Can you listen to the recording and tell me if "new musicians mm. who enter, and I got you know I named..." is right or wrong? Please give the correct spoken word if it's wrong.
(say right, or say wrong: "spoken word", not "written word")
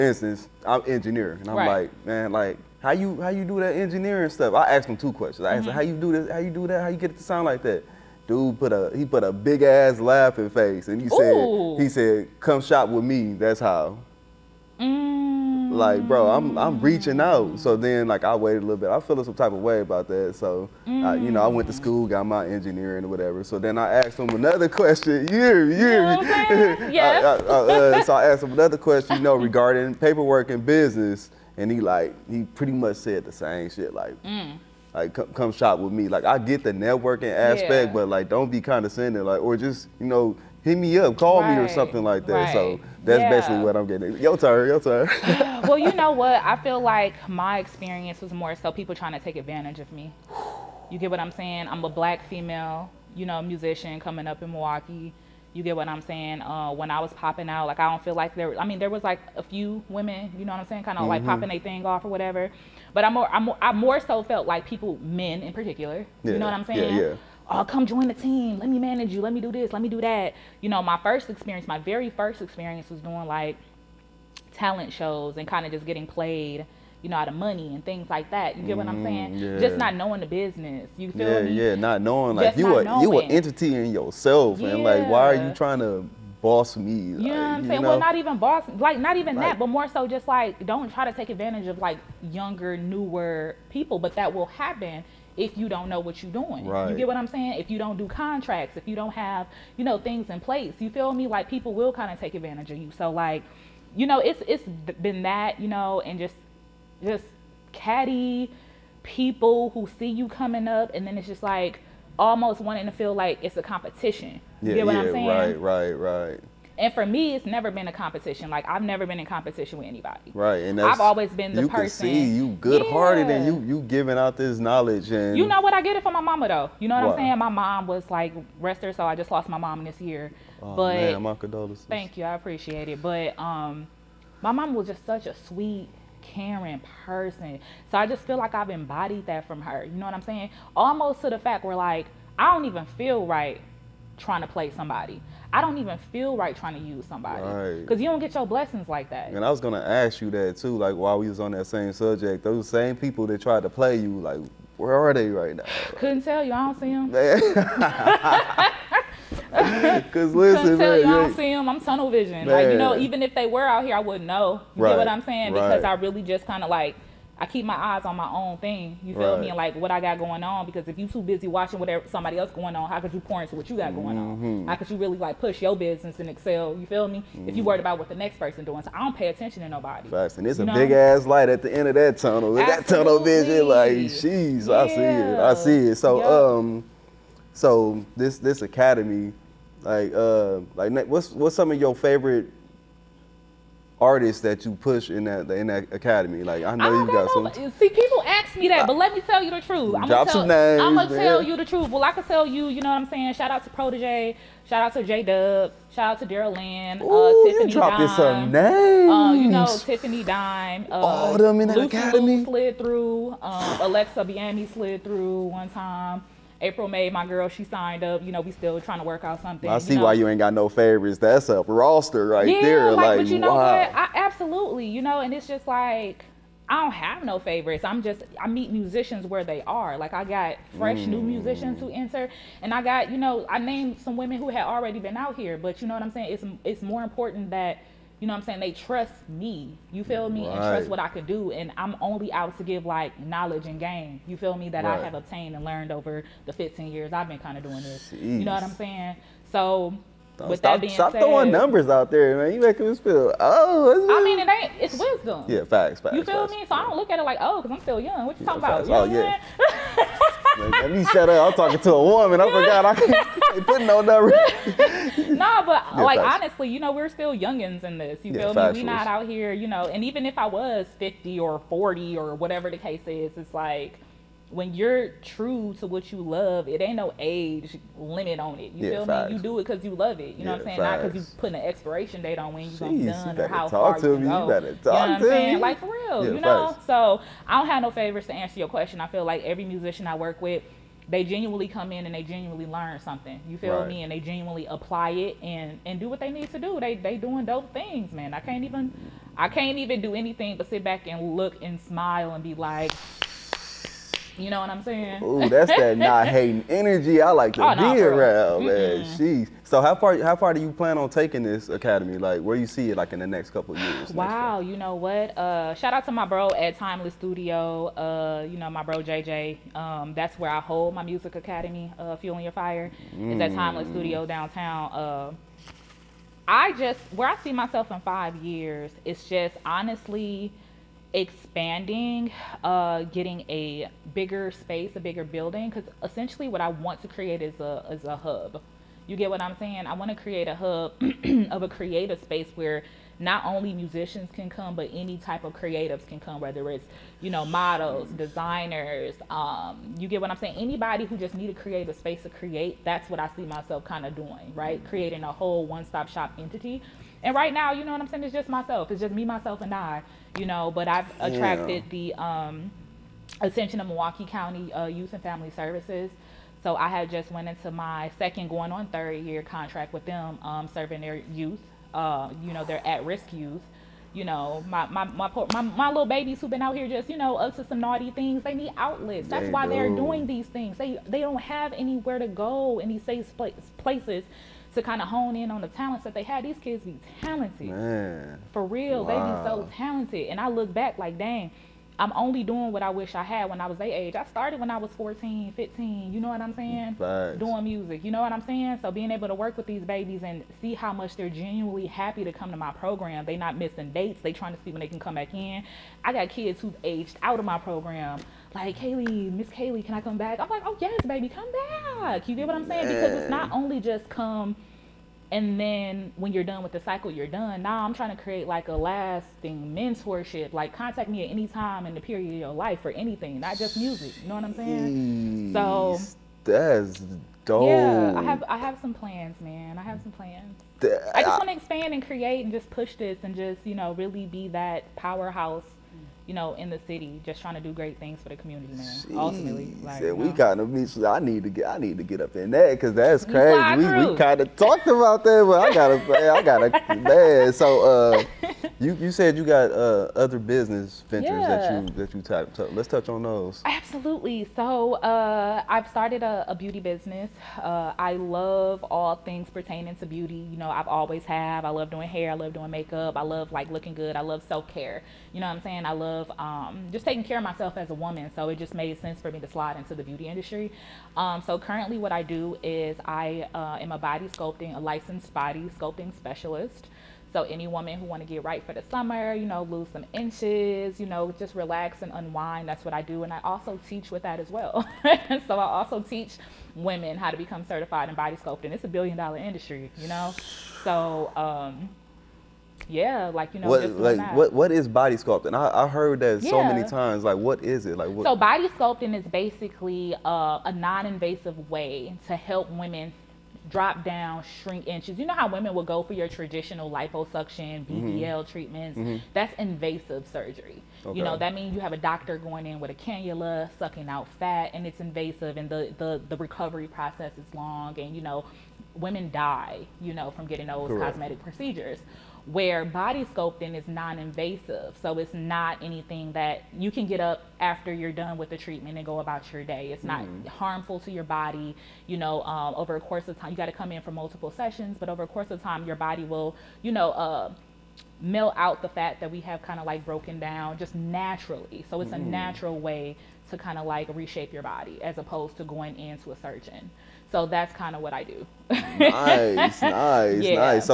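right.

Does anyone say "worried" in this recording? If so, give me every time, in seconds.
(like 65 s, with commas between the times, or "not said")
177 s.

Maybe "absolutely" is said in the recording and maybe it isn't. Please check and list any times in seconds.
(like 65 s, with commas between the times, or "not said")
182 s, 224 s, 453 s.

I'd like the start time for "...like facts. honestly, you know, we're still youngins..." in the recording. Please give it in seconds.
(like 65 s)
266 s.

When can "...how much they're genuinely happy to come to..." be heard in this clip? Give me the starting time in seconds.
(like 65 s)
400 s.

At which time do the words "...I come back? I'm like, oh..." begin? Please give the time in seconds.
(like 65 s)
409 s.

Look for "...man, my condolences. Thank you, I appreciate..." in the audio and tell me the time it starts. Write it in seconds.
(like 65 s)
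130 s.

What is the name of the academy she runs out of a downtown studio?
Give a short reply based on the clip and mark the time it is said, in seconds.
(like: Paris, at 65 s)
Fueling Your Fire, at 322 s.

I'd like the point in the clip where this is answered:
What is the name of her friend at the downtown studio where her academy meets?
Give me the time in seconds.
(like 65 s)
319 s.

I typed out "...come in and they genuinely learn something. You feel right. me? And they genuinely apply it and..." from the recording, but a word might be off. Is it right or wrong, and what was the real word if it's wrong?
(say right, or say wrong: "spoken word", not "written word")
right.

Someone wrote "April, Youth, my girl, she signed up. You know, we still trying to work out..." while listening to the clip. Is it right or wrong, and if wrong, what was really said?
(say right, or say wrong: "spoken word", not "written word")
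wrong: "May", not "Youth".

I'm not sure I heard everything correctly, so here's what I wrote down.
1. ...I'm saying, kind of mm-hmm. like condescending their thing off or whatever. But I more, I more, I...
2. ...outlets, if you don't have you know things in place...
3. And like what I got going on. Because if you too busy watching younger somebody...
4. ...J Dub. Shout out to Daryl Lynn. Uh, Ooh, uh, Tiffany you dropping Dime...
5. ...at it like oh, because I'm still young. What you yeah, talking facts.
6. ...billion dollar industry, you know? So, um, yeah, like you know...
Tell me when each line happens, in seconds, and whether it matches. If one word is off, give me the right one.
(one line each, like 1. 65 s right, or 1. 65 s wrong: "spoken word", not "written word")
1. 60 s wrong: "popping", not "condescending"
2. 98 s wrong: "contracts", not "outlets"
3. 169 s wrong: "whatever", not "younger"
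4. 205 s right
5. 257 s right
6. 488 s right.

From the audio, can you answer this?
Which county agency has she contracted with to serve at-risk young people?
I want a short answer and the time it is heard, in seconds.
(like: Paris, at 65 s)
Youth and Family Services, at 364 s.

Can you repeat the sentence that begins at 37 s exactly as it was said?
but like don't be condescending, like or just you know hit me up, call right.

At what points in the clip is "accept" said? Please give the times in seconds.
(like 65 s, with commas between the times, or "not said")
not said.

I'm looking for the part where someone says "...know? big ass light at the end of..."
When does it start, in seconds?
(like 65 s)
180 s.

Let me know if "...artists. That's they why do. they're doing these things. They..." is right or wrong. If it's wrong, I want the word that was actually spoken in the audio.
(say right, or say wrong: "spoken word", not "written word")
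wrong: "outlets", not "artists".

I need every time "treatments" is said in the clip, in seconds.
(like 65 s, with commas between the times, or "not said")
508 s, 528 s.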